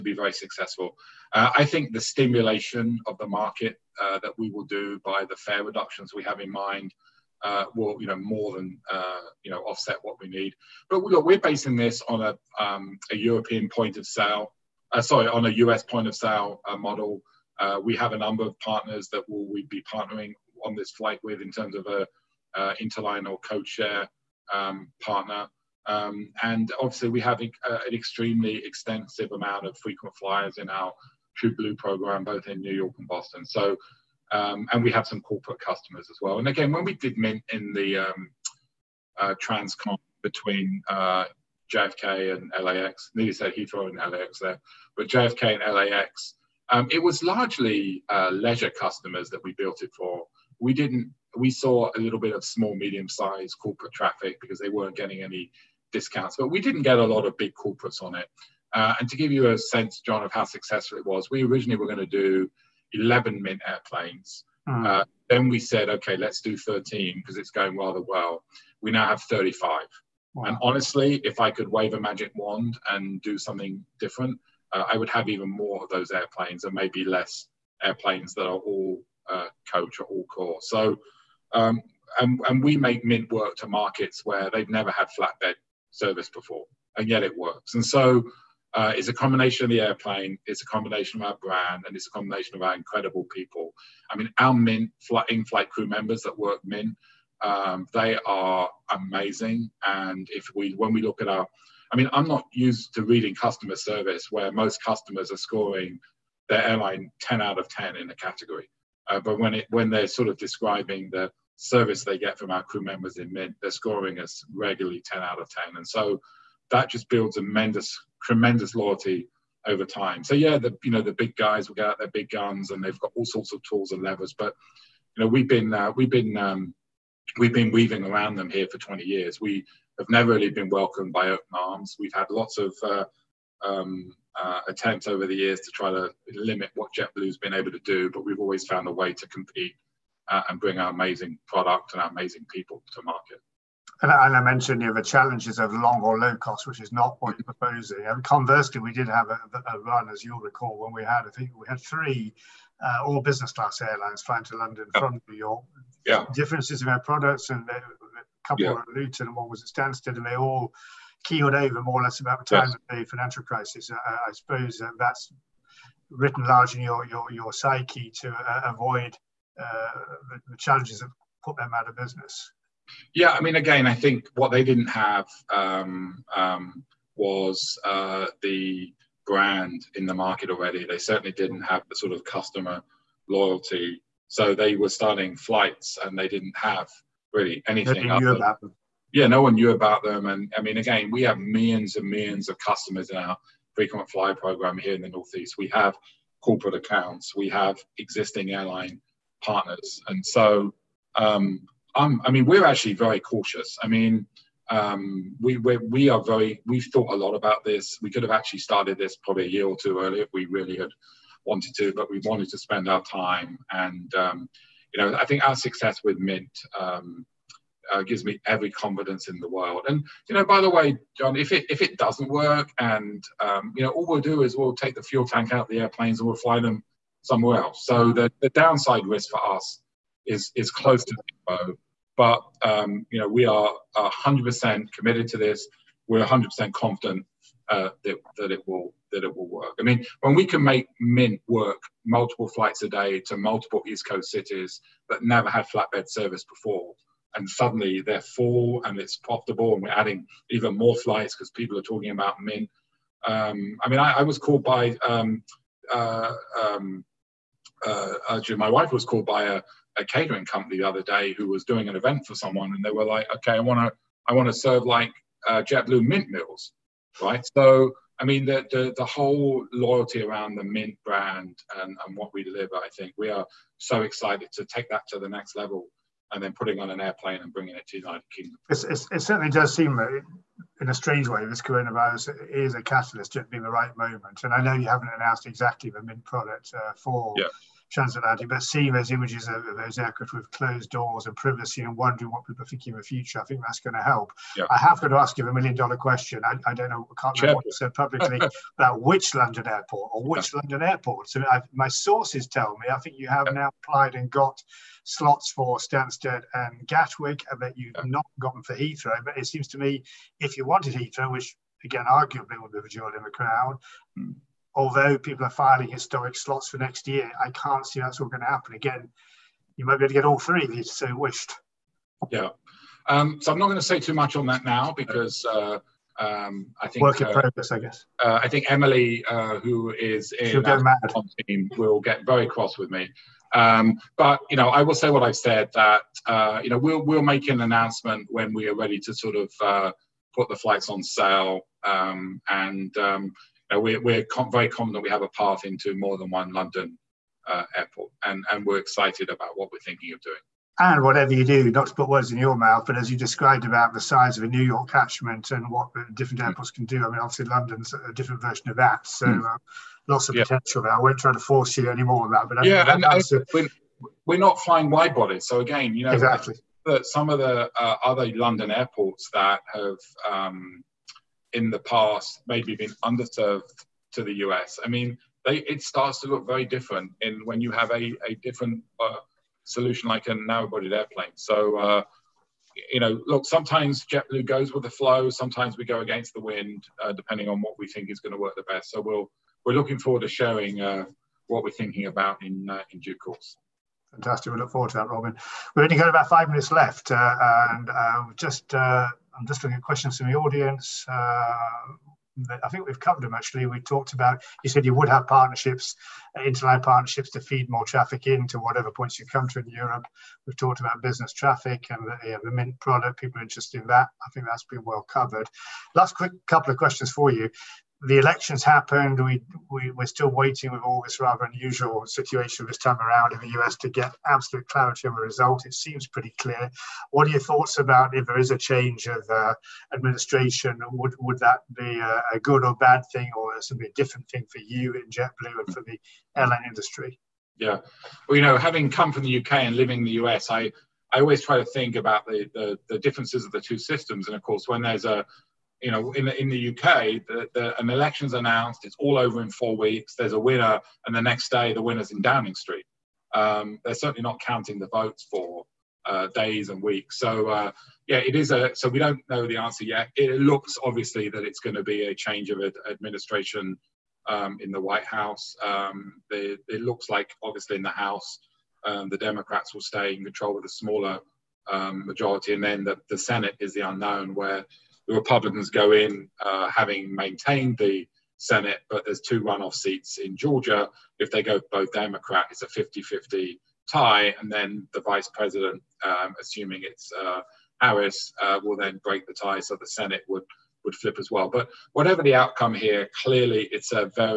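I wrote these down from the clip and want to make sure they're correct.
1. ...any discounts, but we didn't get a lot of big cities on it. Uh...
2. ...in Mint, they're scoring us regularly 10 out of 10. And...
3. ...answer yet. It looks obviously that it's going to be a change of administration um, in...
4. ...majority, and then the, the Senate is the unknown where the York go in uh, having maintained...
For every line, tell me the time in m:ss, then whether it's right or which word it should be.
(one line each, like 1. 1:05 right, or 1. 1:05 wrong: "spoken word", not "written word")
1. 0:55 wrong: "corporates", not "cities"
2. 1:53 right
3. 7:39 right
4. 7:52 wrong: "Republicans", not "York".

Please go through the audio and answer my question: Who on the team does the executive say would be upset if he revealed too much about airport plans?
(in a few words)
Emily.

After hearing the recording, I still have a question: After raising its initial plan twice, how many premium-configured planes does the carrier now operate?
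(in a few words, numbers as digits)
35.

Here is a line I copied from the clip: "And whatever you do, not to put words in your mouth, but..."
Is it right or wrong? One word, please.
right.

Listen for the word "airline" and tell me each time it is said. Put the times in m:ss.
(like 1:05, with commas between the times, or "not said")
1:46, 2:33, 3:18, 7:16.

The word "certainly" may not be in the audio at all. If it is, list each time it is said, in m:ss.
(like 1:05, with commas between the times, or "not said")
3:00, 4:39, 7:33.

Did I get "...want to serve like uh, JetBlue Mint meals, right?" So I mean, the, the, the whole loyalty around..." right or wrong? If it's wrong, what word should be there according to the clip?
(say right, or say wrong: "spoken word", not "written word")
right.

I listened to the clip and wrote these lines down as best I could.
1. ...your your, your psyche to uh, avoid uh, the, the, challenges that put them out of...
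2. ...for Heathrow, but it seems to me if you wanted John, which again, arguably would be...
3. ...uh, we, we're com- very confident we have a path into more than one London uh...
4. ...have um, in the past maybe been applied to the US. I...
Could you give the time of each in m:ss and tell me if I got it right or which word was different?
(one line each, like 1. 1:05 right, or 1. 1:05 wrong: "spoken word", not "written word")
1. 2:46 right
2. 5:08 wrong: "Heathrow", not "John"
3. 5:43 right
4. 6:09 wrong: "underserved", not "applied".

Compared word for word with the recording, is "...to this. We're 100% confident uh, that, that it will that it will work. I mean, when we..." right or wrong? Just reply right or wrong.
right.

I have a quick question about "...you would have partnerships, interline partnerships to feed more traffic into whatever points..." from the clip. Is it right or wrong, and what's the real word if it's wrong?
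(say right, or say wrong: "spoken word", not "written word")
right.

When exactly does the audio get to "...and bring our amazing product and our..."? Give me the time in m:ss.
2:20.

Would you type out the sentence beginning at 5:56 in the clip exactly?
airports can do, I mean, obviously London's a different version of that.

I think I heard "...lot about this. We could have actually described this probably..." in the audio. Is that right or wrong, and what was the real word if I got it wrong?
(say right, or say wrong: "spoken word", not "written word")
wrong: "started", not "described".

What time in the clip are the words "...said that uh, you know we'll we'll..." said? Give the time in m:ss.
5:35.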